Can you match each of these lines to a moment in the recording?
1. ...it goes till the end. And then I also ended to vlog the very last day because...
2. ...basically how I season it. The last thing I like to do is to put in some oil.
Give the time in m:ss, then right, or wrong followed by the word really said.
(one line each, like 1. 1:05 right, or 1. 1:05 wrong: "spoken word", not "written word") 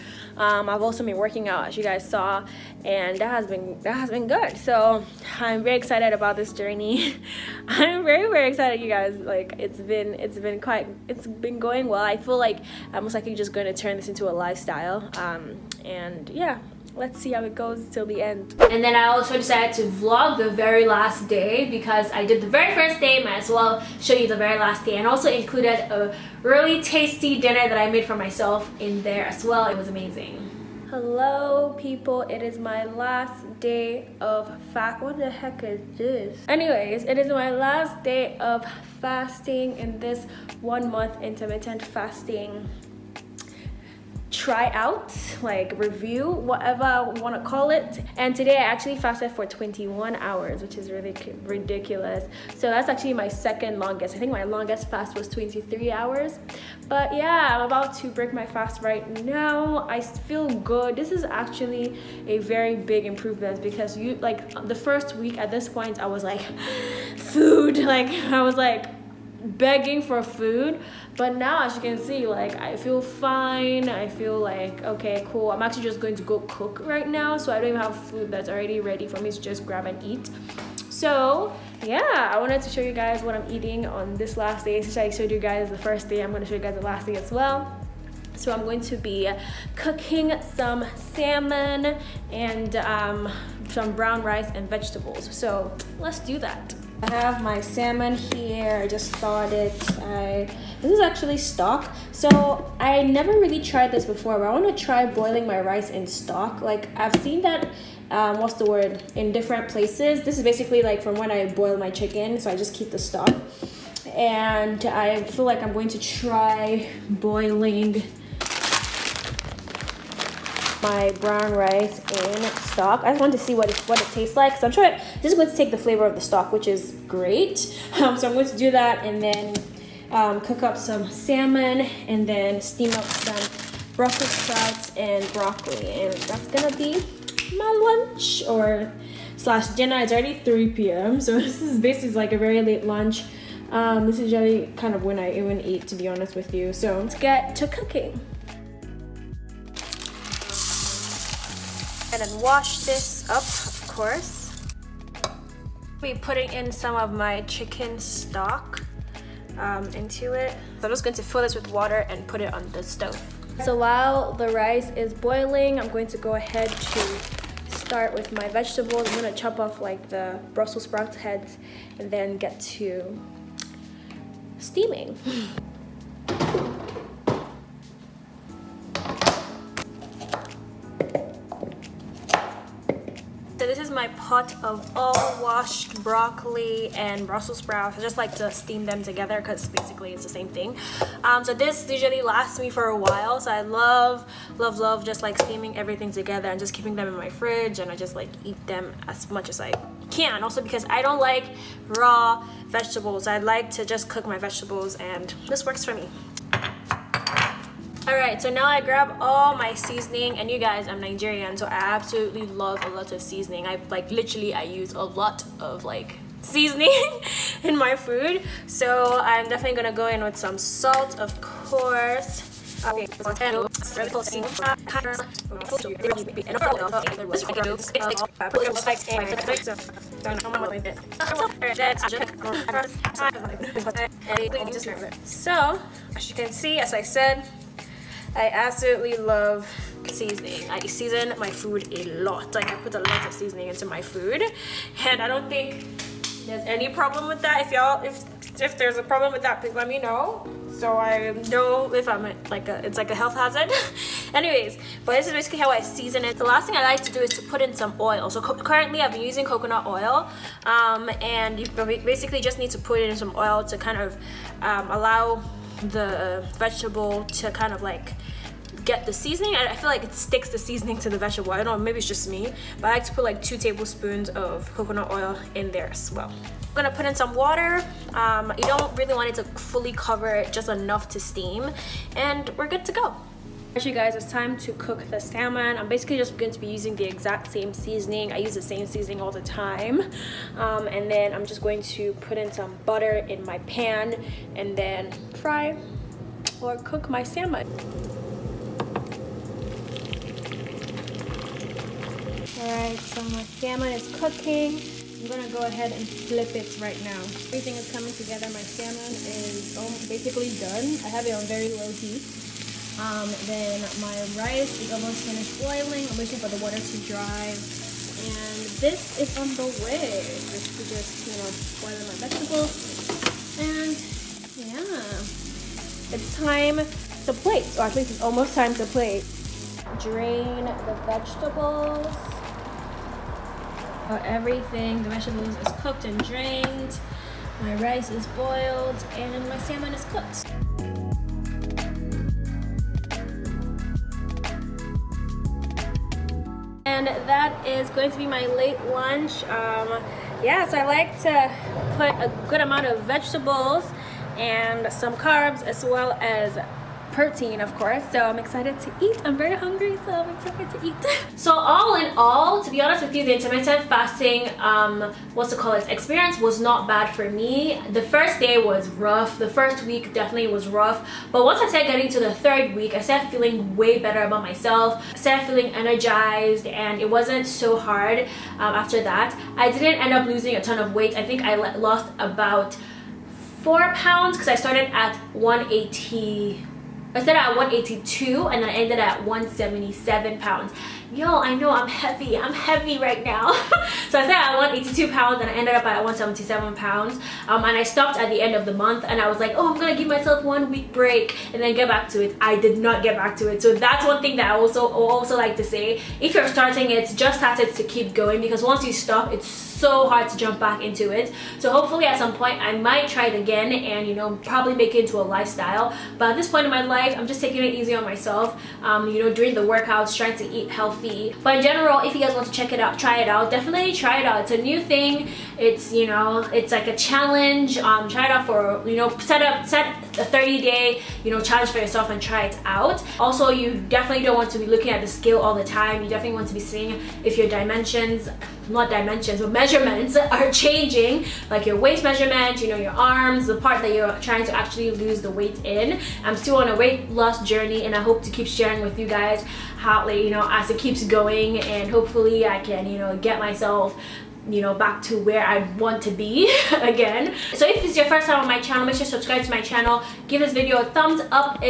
1. 0:17 wrong: "decided", not "ended"
2. 4:15 right.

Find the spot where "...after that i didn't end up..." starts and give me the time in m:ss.
6:18.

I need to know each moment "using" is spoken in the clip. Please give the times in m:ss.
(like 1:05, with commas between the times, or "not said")
4:19, 4:46.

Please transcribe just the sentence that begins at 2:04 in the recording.
So I'm sure just going to take the flavor of the stock, which is great.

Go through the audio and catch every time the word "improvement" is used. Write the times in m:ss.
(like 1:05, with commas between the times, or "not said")
1:03.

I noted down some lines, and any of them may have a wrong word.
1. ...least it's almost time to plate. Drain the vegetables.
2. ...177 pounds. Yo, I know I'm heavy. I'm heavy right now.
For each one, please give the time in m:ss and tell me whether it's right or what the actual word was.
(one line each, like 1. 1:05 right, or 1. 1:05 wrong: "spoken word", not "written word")
1. 5:27 right
2. 6:29 right.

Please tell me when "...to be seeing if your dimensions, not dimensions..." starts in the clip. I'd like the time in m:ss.
7:16.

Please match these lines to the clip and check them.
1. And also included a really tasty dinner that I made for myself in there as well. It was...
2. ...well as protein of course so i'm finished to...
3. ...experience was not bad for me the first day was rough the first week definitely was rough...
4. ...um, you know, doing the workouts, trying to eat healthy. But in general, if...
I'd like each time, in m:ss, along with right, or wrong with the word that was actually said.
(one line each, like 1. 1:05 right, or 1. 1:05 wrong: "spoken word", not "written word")
1. 0:24 right
2. 5:55 wrong: "excited", not "finished"
3. 6:05 right
4. 6:58 right.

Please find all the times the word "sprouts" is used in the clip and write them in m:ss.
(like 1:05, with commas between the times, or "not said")
2:14, 2:50, 3:07.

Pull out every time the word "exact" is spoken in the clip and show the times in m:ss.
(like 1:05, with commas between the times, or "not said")
4:47.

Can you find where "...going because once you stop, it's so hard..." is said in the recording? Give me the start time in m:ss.
6:48.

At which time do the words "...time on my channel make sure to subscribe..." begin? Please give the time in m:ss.
7:38.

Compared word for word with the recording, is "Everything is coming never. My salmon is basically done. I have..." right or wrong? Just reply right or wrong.
wrong.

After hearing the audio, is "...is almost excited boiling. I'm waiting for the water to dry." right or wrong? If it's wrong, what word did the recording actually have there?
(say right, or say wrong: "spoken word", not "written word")
wrong: "finished", not "excited".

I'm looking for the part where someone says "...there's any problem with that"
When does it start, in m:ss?
4:06.